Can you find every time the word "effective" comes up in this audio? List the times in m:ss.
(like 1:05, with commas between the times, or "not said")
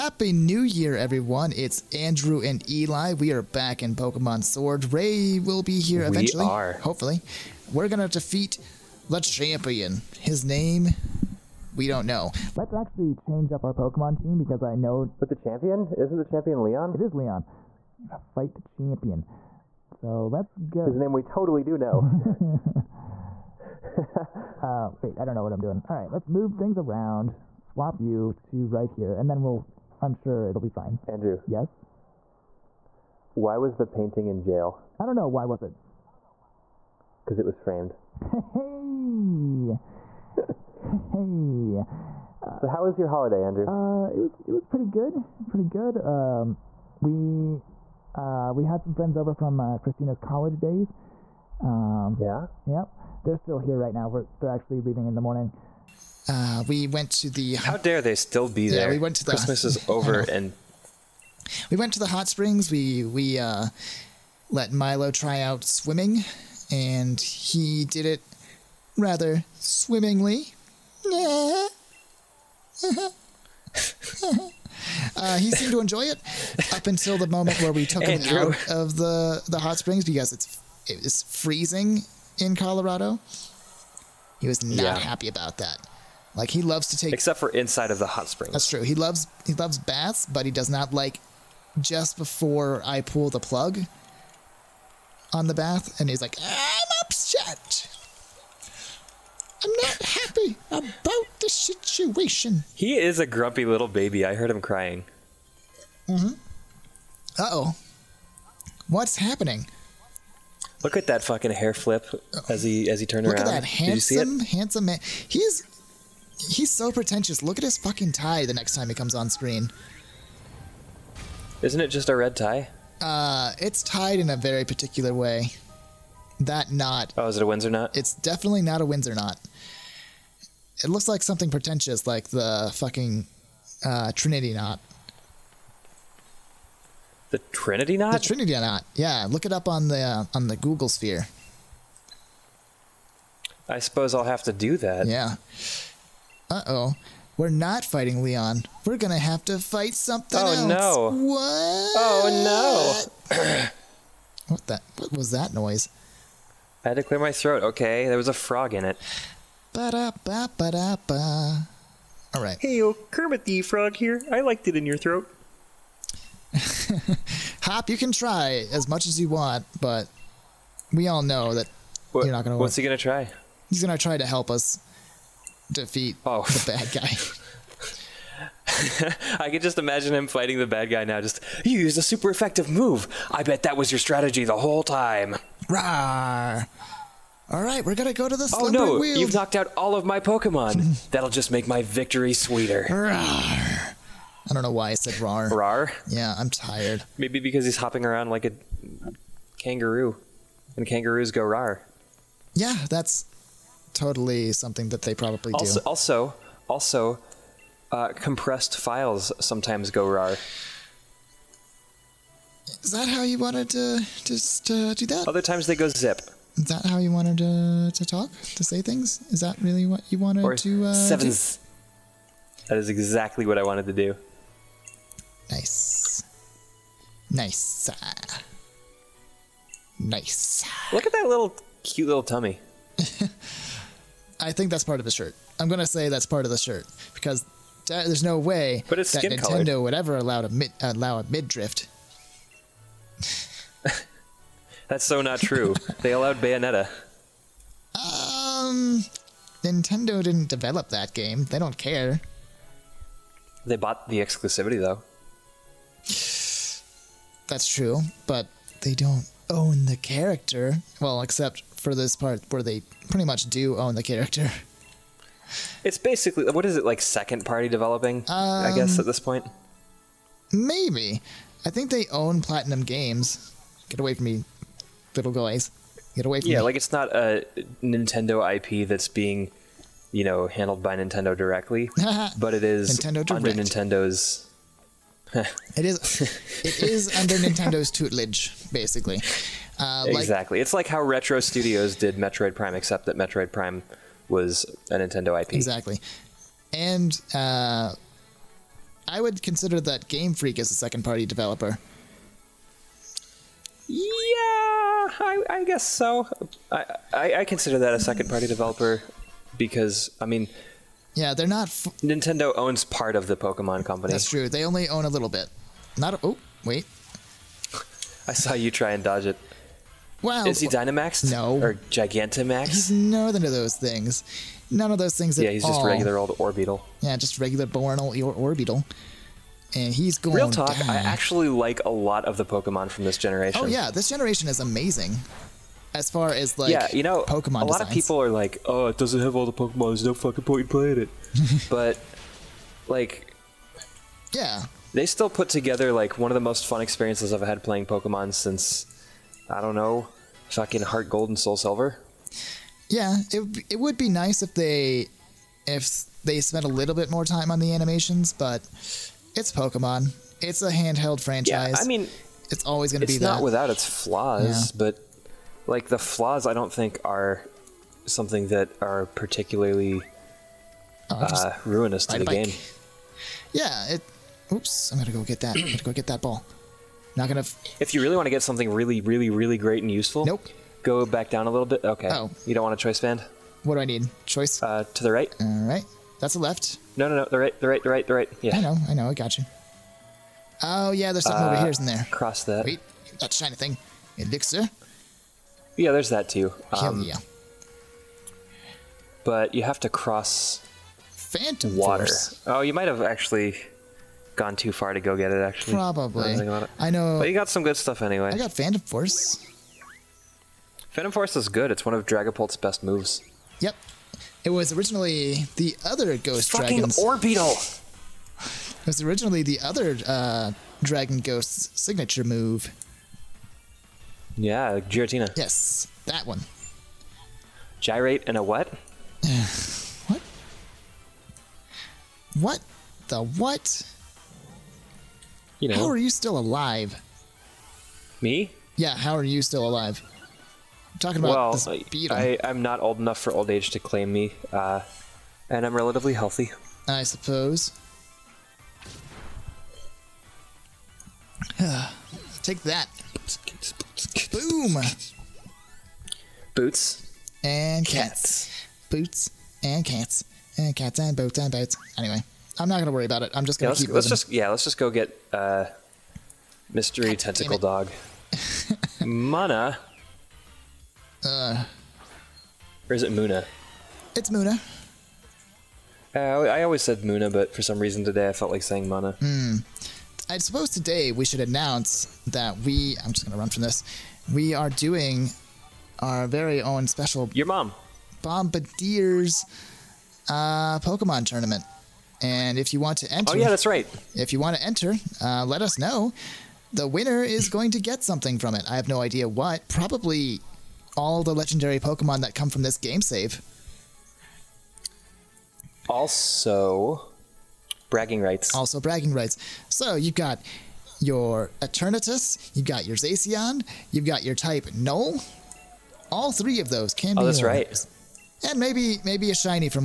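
3:02.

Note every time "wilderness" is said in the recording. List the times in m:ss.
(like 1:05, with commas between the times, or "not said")
not said.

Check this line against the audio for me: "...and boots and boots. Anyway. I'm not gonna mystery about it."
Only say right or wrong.
wrong.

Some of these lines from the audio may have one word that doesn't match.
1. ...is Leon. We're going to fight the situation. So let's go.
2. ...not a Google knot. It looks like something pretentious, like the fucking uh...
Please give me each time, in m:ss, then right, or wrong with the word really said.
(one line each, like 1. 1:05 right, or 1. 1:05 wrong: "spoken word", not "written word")
1. 0:17 wrong: "champion", not "situation"
2. 2:08 wrong: "Windsor", not "Google".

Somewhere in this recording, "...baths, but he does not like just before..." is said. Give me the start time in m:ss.
1:29.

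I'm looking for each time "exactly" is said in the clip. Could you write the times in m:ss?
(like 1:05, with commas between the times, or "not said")
3:42, 4:50, 4:55.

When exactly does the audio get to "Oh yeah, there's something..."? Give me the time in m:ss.
6:30.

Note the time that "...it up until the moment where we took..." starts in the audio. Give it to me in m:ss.
1:16.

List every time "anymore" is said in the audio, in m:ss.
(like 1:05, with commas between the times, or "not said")
not said.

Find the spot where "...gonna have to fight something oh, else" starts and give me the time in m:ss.
2:28.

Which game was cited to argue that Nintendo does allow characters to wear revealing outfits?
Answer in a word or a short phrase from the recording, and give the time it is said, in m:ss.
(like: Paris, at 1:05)
Bayonetta, at 4:06.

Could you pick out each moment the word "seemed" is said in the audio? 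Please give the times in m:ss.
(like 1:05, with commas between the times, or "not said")
1:15.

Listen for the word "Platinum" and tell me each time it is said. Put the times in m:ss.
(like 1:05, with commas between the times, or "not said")
4:32.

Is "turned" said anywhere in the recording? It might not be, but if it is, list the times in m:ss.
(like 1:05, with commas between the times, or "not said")
1:53.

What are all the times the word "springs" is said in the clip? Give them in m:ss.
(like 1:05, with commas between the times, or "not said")
1:02, 1:19, 1:28.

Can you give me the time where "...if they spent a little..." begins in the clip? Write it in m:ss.
5:55.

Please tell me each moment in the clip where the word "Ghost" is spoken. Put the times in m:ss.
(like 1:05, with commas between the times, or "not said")
6:56, 7:01.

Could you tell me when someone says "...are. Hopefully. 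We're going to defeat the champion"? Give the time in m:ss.
0:06.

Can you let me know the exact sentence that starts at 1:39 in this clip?
I'm not happy about the situation.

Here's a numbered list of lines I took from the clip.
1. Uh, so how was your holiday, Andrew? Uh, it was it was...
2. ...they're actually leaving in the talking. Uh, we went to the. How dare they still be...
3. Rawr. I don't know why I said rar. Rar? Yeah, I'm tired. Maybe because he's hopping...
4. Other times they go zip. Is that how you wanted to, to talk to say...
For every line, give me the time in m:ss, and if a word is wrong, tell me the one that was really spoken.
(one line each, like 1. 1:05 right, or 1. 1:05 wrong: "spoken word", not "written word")
1. 0:42 right
2. 0:54 wrong: "morning", not "talking"
3. 3:12 right
4. 3:35 right.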